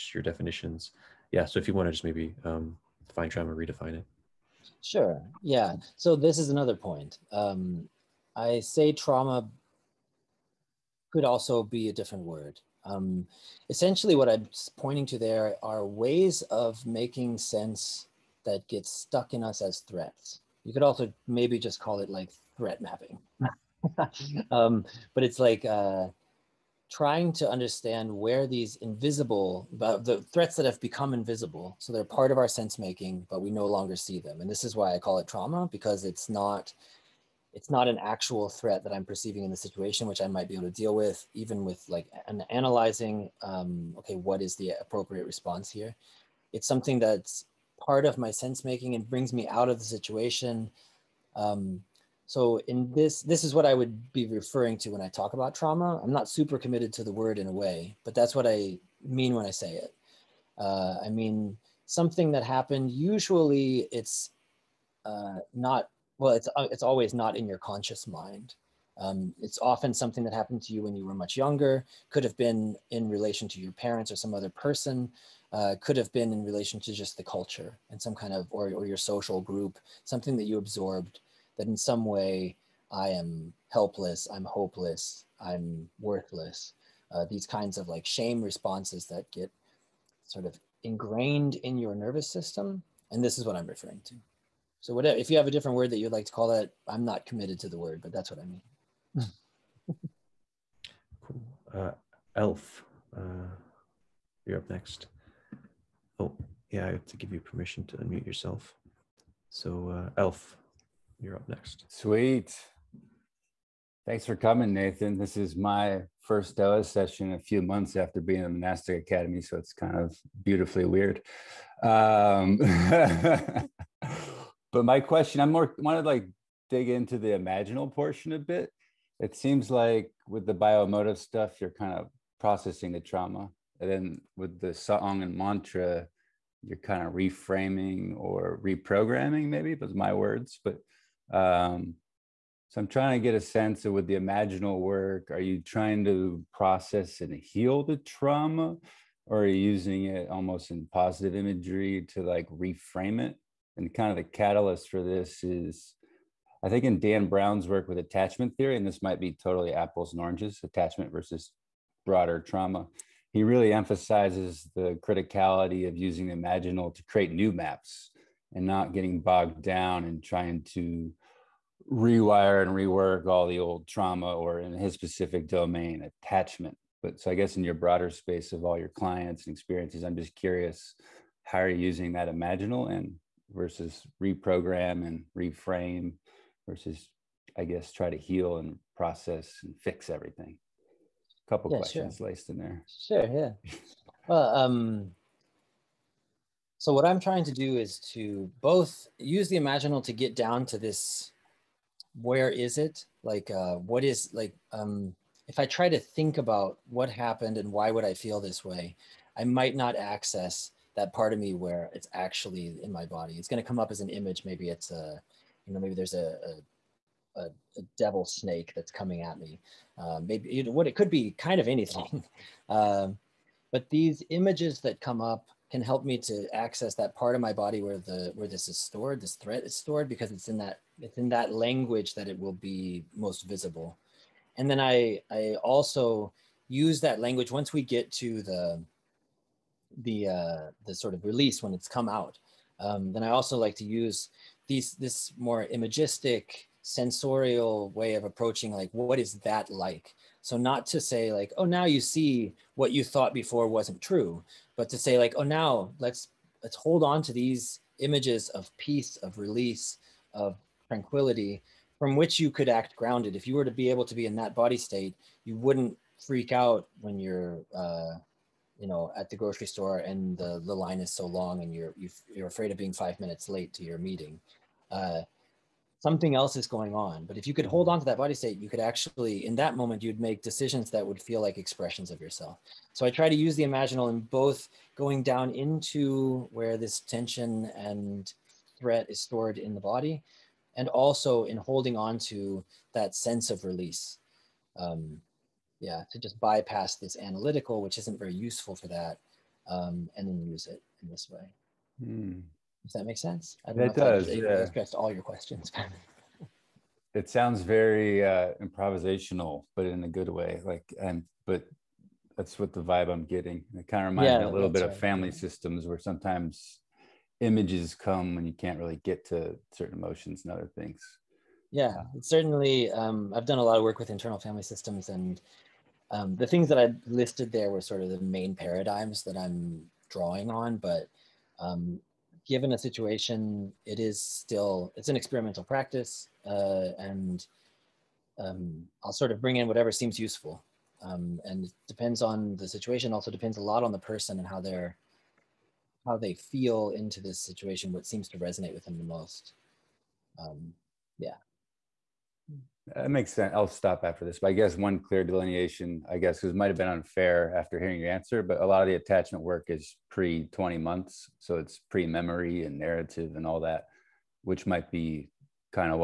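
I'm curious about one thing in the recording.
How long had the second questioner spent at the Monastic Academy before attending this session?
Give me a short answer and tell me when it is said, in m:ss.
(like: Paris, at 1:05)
a few months, at 1:57.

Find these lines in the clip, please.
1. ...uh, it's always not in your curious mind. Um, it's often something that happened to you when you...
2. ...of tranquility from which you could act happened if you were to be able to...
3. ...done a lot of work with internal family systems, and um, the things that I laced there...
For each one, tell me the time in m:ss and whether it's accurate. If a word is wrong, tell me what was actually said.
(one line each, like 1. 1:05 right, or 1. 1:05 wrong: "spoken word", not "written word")
1. 1:06 wrong: "conscious", not "curious"
2. 4:20 wrong: "grounded", not "happened"
3. 5:23 wrong: "listed", not "laced".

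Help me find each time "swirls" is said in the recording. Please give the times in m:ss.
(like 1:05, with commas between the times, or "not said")
not said.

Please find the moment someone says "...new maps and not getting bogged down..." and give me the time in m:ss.
2:47.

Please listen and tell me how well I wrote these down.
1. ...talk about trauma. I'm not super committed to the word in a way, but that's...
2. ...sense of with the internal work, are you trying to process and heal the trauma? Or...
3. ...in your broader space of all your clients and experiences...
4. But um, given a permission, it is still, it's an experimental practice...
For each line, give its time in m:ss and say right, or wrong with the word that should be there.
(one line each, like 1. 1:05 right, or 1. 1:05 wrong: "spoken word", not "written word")
1. 0:55 right
2. 2:23 wrong: "imaginal", not "internal"
3. 2:57 right
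4. 5:30 wrong: "situation", not "permission".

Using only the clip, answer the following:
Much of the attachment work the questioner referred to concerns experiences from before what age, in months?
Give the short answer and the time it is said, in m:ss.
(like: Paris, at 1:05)
20 months, at 6:00.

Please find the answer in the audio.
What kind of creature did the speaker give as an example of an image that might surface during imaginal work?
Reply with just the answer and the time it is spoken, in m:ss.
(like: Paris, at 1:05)
a devil snake, at 3:37.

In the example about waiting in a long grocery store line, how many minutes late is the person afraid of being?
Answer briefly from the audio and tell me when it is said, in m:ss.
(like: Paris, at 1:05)
5, at 4:32.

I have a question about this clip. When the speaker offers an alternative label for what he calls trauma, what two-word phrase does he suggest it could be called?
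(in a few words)
threat mapping.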